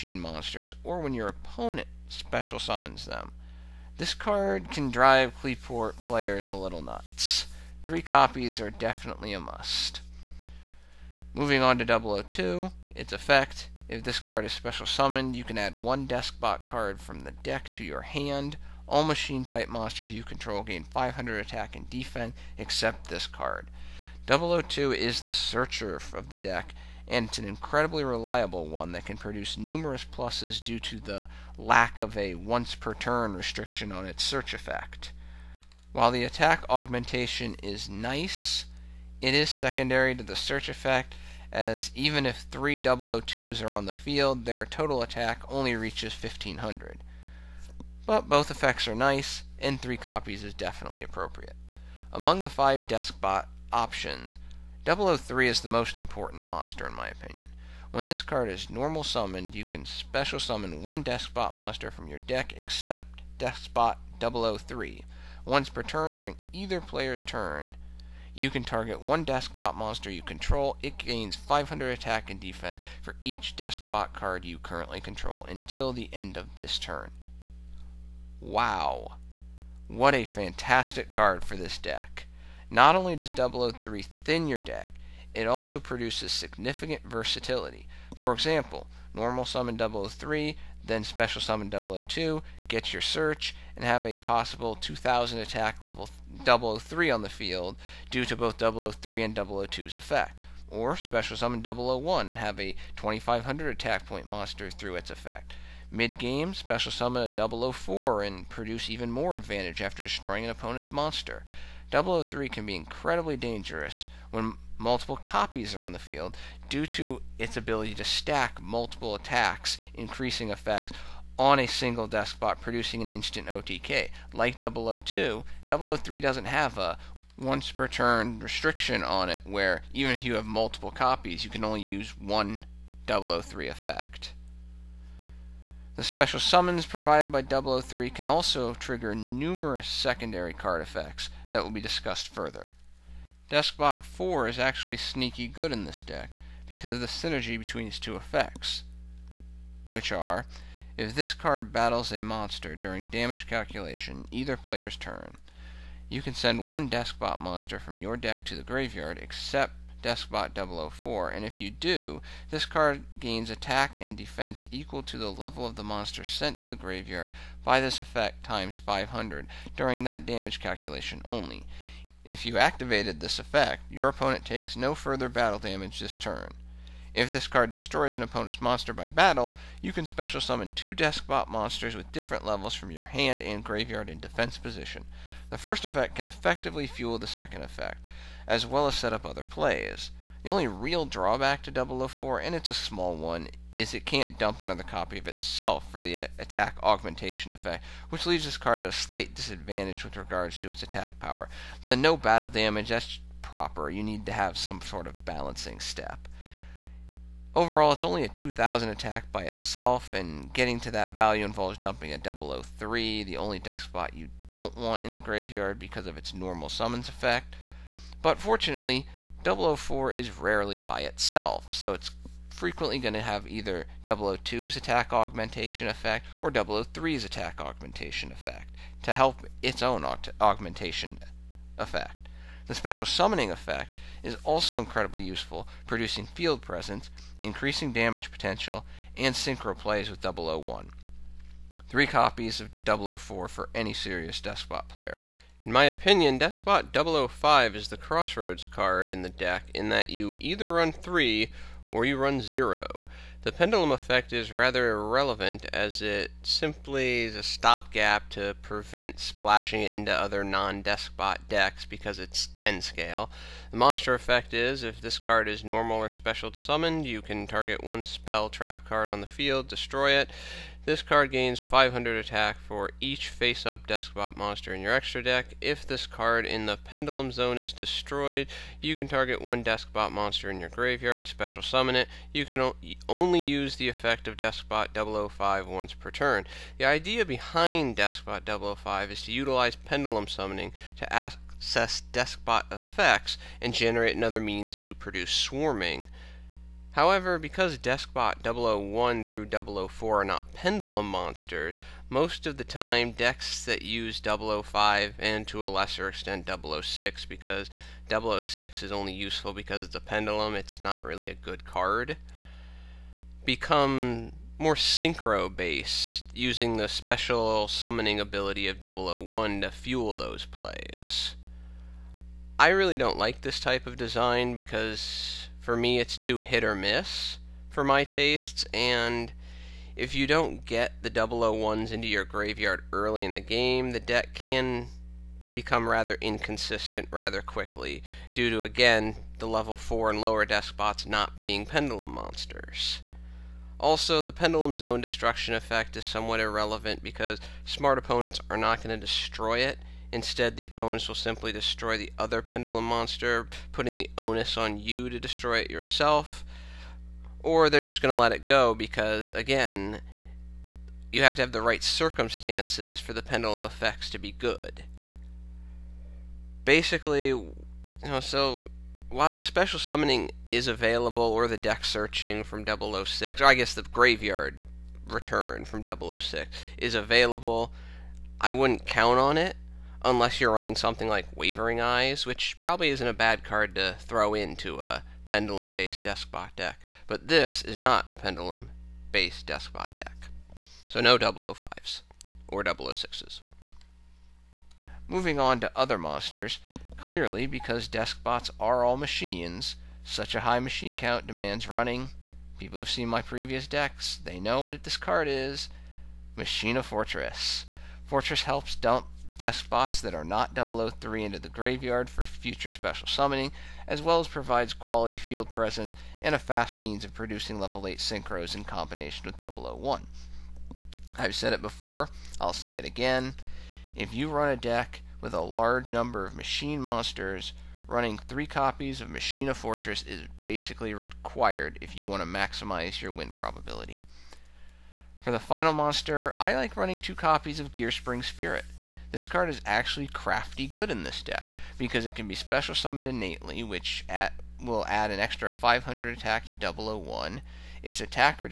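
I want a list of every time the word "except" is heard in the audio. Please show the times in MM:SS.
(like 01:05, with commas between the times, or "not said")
00:22, 01:02, 02:39.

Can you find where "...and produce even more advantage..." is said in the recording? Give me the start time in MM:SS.
01:48.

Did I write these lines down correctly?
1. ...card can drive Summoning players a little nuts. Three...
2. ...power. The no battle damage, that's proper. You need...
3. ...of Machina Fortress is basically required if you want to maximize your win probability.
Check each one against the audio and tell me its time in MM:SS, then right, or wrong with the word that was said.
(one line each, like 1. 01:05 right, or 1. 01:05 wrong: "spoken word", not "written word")
1. 00:04 wrong: "Qliphort", not "Summoning"
2. 03:21 right
3. 07:09 right.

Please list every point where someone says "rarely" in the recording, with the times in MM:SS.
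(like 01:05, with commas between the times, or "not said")
03:40.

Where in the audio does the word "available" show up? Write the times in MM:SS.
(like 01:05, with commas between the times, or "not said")
06:10, 06:16.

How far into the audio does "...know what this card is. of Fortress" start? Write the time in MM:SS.
06:44.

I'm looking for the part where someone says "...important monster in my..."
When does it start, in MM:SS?
00:55.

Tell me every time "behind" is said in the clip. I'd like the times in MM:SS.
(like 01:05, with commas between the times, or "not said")
04:47.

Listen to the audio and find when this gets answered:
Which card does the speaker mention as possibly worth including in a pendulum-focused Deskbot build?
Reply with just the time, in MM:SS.
06:21.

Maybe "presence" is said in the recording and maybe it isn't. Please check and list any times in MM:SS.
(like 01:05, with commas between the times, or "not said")
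03:56, 06:55.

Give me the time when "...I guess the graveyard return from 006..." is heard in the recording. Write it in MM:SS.
06:13.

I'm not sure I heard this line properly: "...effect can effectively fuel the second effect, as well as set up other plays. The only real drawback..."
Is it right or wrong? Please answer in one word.
right.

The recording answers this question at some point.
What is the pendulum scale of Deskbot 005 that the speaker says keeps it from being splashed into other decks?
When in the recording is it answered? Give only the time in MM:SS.
04:22.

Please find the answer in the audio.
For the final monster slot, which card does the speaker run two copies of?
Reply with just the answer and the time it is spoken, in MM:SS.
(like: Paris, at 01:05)
Gearspring Spirit, at 07:17.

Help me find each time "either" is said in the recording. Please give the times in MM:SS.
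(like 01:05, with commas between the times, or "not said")
01:06, 02:34, 03:43, 04:10.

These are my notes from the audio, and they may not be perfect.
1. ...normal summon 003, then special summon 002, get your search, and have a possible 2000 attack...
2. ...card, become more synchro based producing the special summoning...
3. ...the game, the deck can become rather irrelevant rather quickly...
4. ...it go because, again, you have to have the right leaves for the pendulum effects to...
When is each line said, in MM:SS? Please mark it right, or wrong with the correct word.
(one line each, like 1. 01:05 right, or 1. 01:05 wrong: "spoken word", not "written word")
1. 01:29 right
2. 05:11 wrong: "using", not "producing"
3. 05:33 wrong: "inconsistent", not "irrelevant"
4. 05:58 wrong: "circumstances", not "leaves".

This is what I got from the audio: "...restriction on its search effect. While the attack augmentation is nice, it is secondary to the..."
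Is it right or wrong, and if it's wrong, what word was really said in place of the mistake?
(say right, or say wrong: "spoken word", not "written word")
right.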